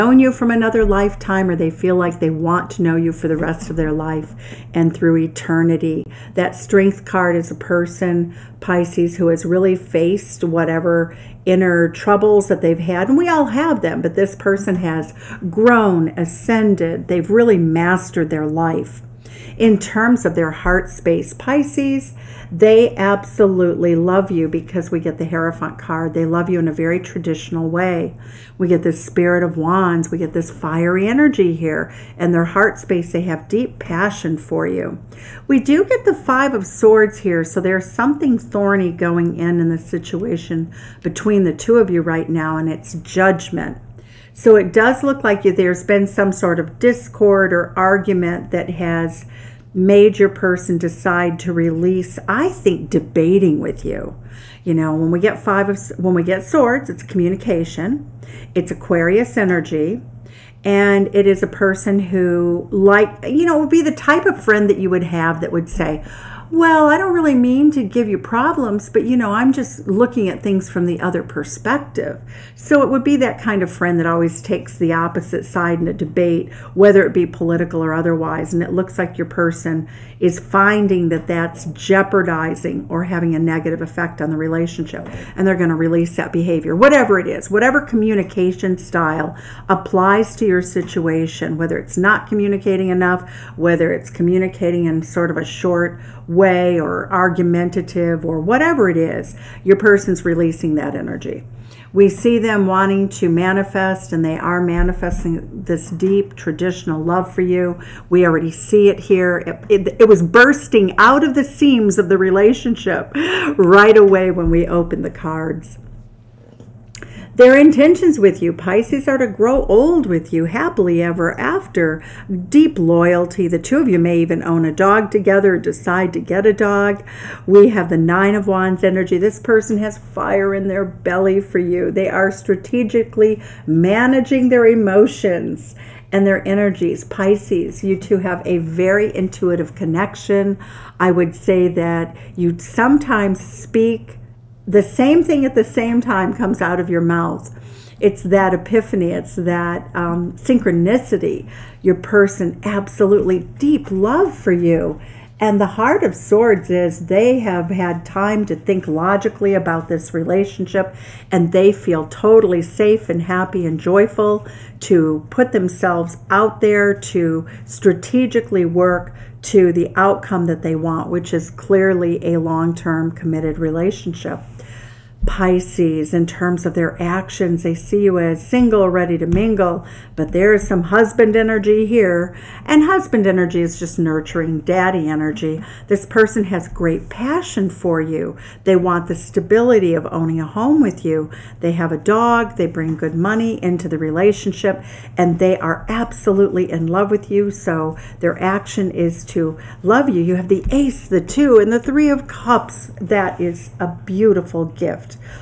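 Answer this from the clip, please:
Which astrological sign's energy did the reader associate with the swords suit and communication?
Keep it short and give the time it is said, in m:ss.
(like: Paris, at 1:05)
Aquarius, at 0:58.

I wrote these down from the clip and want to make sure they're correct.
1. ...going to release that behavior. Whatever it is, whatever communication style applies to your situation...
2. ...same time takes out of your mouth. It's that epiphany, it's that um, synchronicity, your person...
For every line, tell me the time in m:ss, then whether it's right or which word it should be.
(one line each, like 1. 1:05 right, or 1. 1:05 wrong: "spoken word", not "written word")
1. 1:25 right
2. 2:25 wrong: "comes", not "takes".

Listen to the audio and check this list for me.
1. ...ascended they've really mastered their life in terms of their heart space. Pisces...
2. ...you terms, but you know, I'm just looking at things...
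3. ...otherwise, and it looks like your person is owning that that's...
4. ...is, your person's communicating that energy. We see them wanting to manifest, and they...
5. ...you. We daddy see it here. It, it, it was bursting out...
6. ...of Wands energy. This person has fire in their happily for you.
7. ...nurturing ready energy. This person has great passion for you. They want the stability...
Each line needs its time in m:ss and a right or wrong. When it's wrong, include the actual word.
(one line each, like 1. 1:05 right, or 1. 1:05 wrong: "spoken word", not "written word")
1. 0:16 right
2. 1:08 wrong: "problems", not "terms"
3. 1:17 wrong: "finding", not "owning"
4. 1:38 wrong: "releasing", not "communicating"
5. 1:47 wrong: "already", not "daddy"
6. 2:08 wrong: "belly", not "happily"
7. 3:03 wrong: "daddy", not "ready".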